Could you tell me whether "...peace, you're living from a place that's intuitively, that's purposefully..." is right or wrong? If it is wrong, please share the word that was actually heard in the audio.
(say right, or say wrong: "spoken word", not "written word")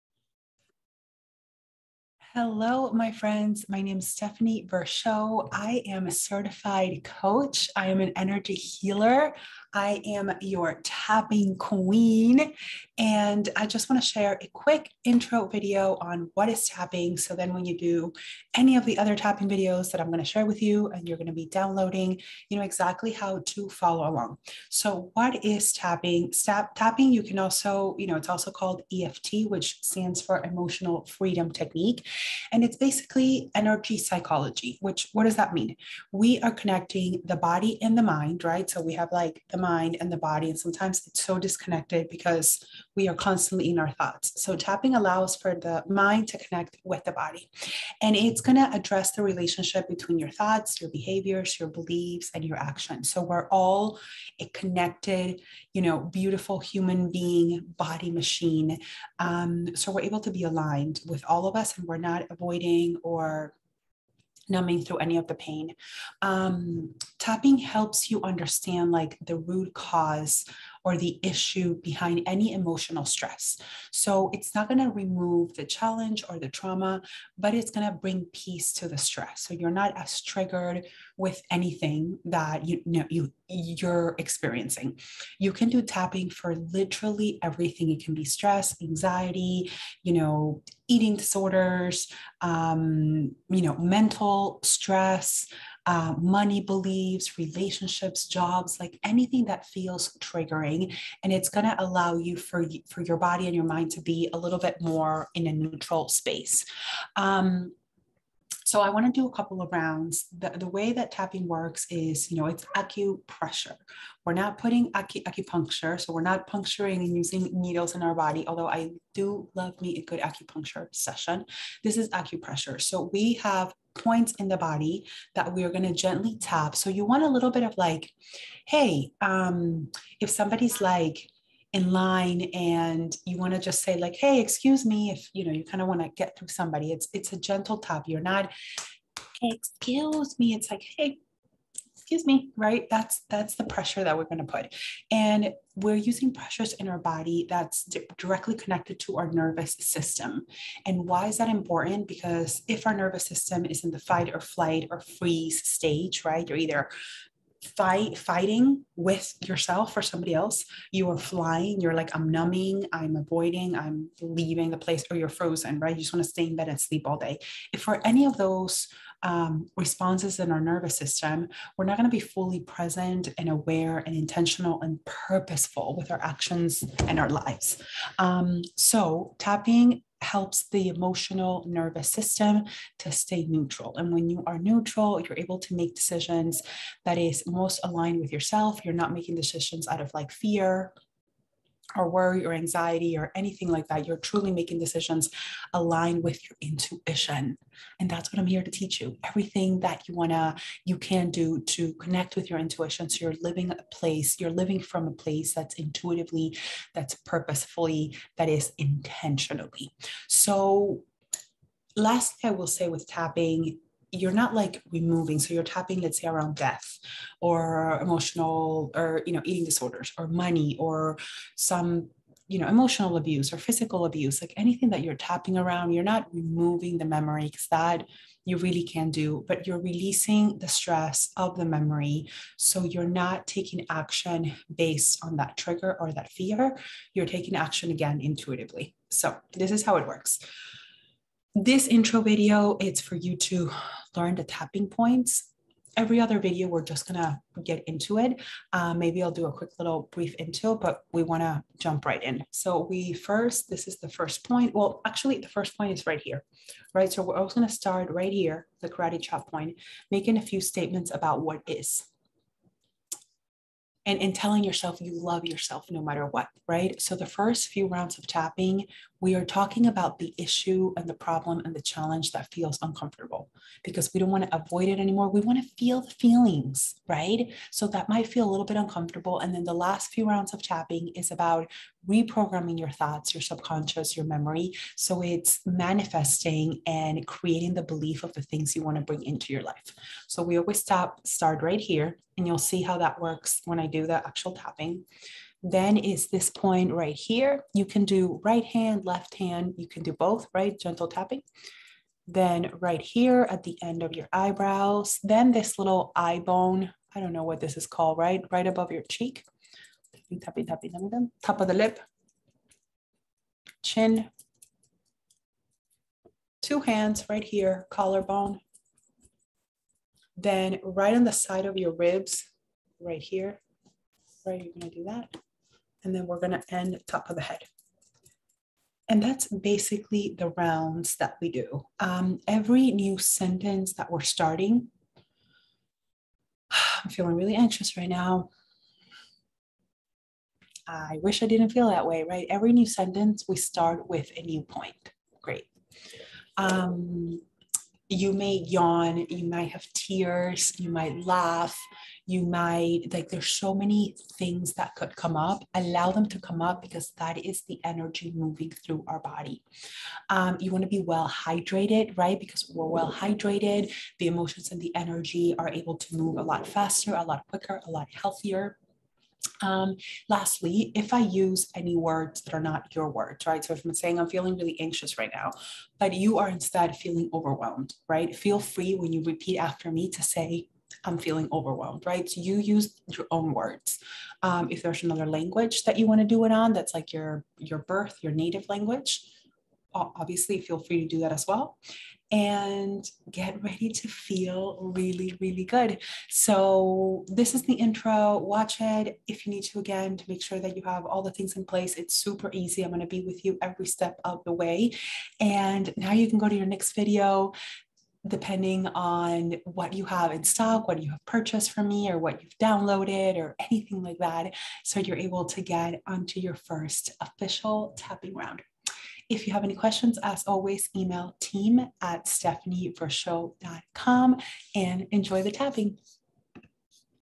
wrong: "place", not "peace".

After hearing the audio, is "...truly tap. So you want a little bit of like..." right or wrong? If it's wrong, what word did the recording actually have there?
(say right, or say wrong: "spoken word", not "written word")
wrong: "gently", not "truly".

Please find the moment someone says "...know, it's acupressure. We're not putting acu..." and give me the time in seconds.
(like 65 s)
112 s.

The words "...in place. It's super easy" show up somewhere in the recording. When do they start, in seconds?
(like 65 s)
401 s.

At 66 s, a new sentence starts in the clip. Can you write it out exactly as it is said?
Um, tapping helps you understand like the root cause or the issue behind any emotional stress.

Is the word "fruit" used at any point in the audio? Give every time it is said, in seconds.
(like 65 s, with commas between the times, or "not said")
not said.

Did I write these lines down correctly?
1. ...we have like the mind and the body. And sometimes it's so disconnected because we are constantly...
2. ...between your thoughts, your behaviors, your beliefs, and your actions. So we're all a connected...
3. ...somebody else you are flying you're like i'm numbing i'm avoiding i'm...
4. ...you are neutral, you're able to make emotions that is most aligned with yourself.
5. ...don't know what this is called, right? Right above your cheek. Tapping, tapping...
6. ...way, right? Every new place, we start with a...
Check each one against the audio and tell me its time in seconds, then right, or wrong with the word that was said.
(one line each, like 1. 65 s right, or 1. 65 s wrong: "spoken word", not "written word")
1. 38 s right
2. 49 s right
3. 160 s right
4. 184 s wrong: "decisions", not "emotions"
5. 307 s right
6. 342 s wrong: "sentence", not "place".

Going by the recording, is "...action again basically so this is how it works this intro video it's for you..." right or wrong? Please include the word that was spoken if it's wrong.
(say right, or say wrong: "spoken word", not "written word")
wrong: "intuitively", not "basically".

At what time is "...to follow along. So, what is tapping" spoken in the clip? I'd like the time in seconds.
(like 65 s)
23 s.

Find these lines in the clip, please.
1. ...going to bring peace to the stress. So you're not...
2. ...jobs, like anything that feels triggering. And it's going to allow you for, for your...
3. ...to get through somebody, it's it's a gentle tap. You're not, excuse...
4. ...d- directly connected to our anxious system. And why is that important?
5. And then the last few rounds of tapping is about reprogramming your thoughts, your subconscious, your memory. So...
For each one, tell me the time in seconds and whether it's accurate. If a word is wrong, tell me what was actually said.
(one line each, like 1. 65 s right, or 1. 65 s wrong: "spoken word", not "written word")
1. 77 s right
2. 98 s right
3. 136 s right
4. 147 s wrong: "nervous", not "anxious"
5. 279 s right.